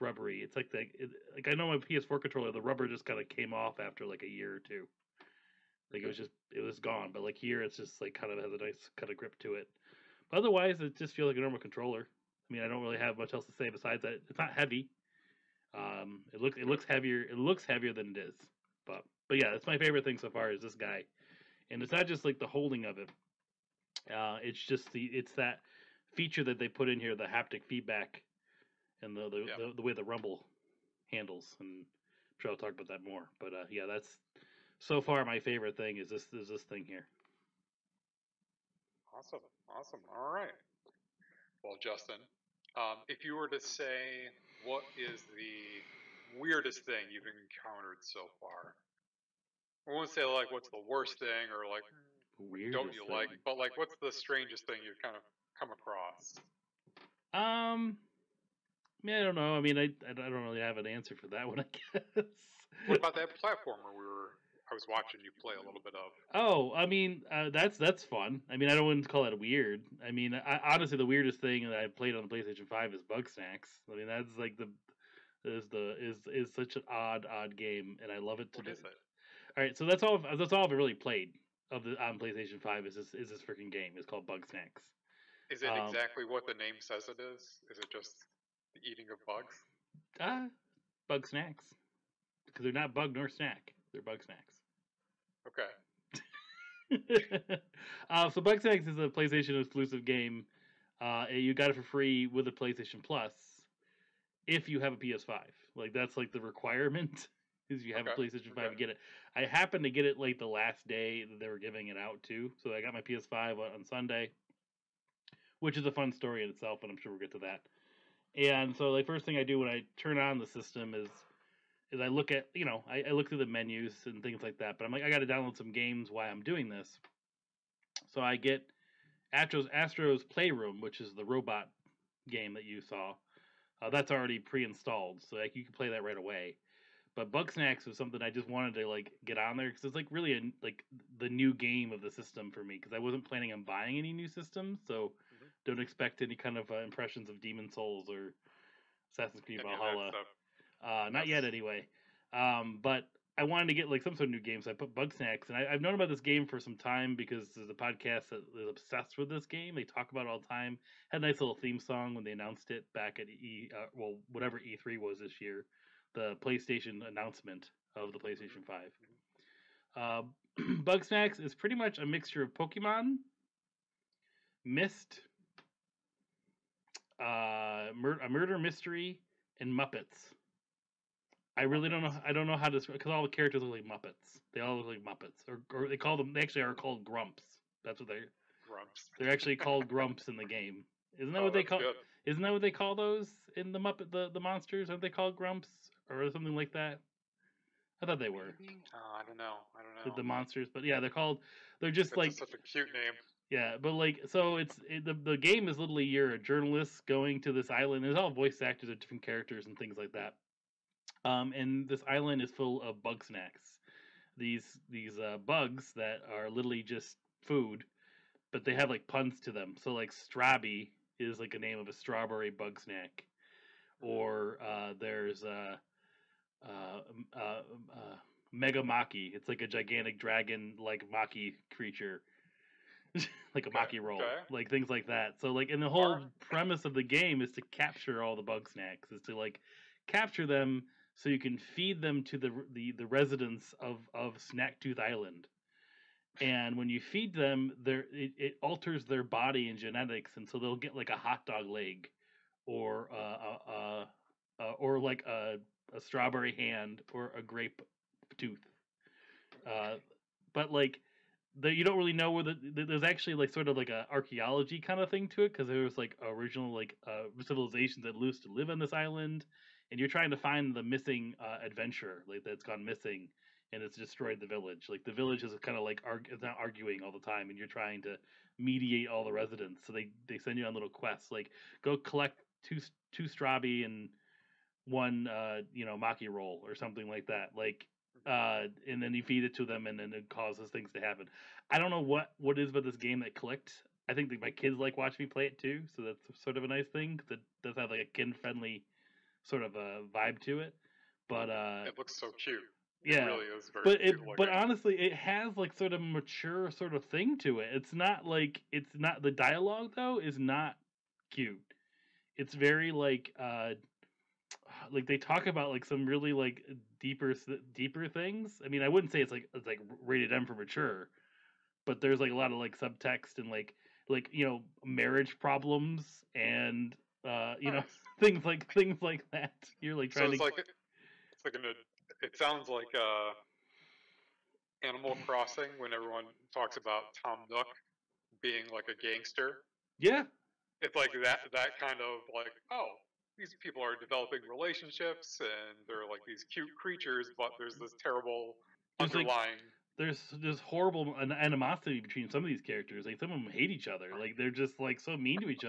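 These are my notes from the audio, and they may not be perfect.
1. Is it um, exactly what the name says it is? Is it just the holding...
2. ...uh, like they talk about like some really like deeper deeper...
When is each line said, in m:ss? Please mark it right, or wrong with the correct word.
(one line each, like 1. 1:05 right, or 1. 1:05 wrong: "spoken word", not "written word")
1. 1:25 wrong: "eating", not "holding"
2. 5:13 right.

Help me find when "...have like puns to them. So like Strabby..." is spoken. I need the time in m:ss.
3:38.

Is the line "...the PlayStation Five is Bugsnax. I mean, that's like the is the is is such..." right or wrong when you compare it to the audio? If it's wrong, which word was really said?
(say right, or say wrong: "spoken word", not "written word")
right.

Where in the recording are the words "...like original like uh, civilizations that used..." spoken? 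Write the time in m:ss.
4:25.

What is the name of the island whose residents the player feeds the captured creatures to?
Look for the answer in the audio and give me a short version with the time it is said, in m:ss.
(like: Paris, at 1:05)
Snacktooth Island, at 4:04.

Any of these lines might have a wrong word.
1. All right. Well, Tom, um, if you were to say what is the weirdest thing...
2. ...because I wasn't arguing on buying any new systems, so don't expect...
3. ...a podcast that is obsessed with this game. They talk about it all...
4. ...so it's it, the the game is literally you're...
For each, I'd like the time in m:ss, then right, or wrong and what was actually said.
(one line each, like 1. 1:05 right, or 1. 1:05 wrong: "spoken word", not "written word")
1. 0:40 wrong: "Justin", not "Tom"
2. 2:22 wrong: "planning", not "arguing"
3. 2:37 right
4. 3:24 right.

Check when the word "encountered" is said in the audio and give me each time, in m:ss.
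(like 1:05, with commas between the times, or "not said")
0:47.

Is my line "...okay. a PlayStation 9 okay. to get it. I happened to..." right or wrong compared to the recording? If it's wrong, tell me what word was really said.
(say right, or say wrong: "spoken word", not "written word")
wrong: "5", not "9".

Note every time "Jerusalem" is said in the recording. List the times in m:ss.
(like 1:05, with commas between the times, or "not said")
not said.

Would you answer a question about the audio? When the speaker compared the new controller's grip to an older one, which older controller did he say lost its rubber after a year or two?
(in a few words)
PS4 controller.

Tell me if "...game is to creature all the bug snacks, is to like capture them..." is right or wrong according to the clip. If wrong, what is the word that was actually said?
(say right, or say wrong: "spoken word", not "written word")
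wrong: "capture", not "creature".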